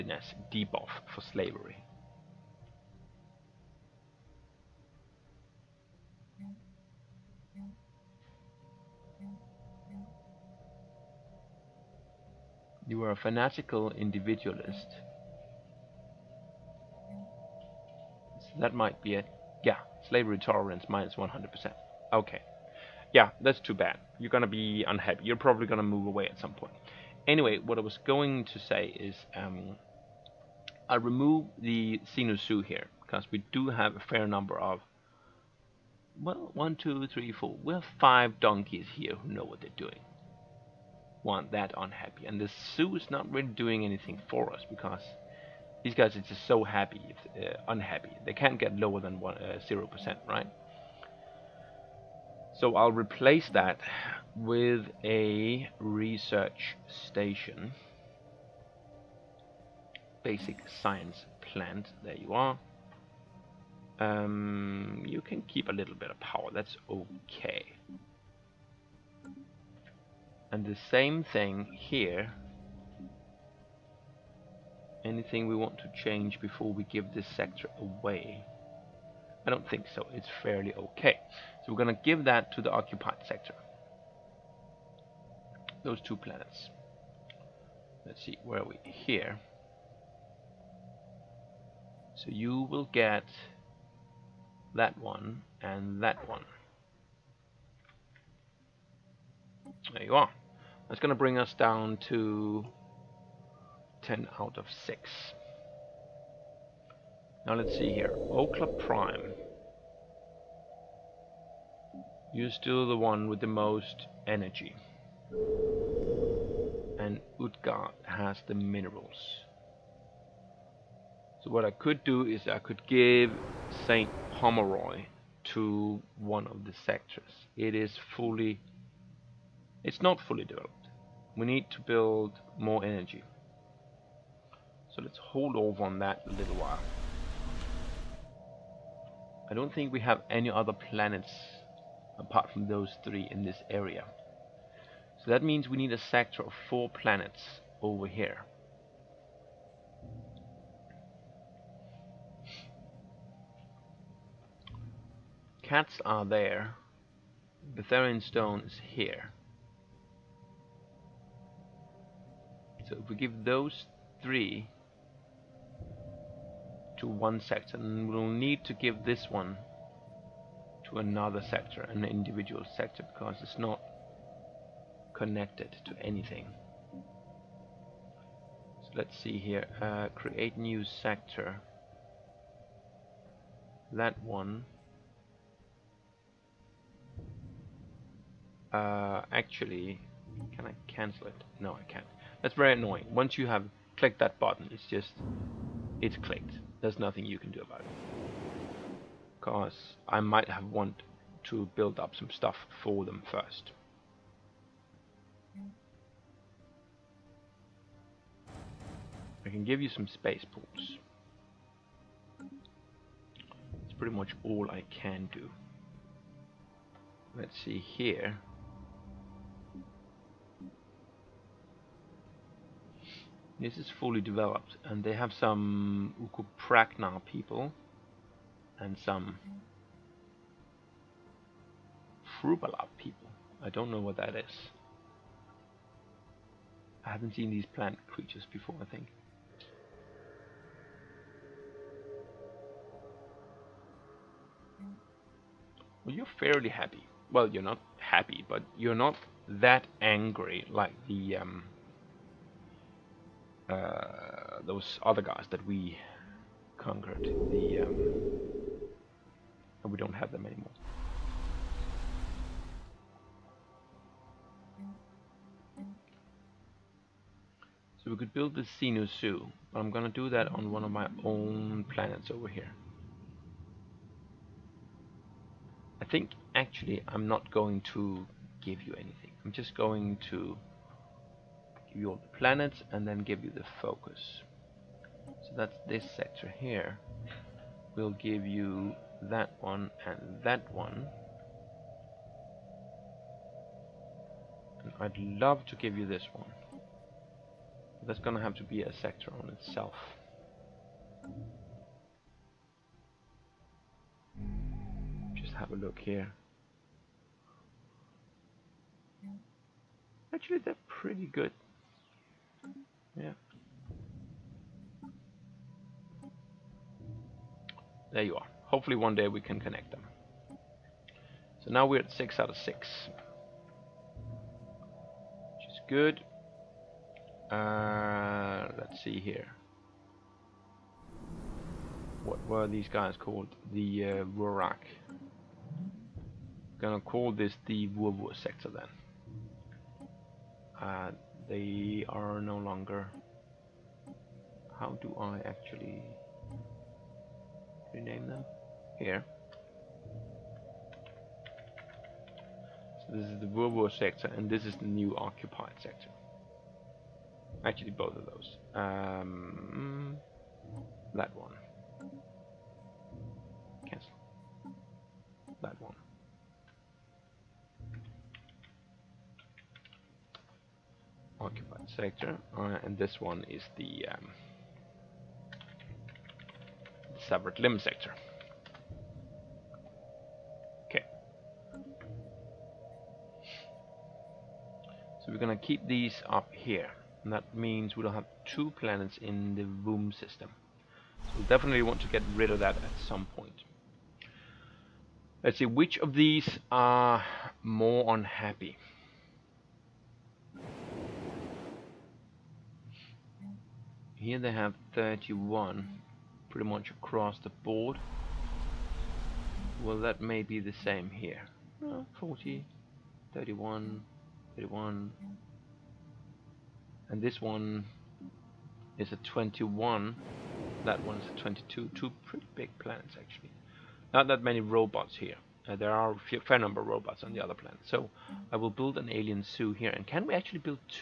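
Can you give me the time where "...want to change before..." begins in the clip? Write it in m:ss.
1:15.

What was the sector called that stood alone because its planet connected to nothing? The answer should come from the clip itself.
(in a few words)
Separate limb sector.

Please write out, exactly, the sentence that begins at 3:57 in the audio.
I haven't seen these plant creatures before, I think.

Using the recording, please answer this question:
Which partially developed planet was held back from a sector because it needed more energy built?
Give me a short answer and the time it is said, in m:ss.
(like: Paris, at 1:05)
St. Pomeroy, at 2:03.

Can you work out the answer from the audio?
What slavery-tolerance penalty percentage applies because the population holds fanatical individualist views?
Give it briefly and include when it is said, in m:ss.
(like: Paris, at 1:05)
-100%, at 0:20.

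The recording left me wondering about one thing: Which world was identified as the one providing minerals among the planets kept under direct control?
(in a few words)
Utgard.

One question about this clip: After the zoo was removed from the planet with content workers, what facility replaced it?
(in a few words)
Research station.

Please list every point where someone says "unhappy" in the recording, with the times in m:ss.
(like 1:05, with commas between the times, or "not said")
0:24, 0:41, 0:47, 6:38.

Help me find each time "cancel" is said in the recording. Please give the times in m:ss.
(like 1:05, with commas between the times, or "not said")
3:10, 6:03.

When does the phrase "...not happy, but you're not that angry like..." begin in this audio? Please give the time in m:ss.
4:07.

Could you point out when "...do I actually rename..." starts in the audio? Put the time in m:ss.
5:45.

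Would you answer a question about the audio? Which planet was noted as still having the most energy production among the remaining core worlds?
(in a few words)
Okla Prime.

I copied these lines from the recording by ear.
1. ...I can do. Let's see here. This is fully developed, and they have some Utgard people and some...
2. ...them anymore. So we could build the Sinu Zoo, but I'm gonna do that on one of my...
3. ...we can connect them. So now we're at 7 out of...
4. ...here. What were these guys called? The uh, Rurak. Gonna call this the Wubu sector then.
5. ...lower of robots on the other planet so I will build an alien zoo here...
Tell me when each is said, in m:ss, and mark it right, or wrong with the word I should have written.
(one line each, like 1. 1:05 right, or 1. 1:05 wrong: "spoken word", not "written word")
1. 3:34 wrong: "Ukuprakna", not "Utgard"
2. 4:20 right
3. 5:19 wrong: "6", not "7"
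4. 5:29 right
5. 7:06 wrong: "number", not "lower".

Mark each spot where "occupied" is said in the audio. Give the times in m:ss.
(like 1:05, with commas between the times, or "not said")
1:22, 5:55, 6:11.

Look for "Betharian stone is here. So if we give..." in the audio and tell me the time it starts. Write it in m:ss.
2:37.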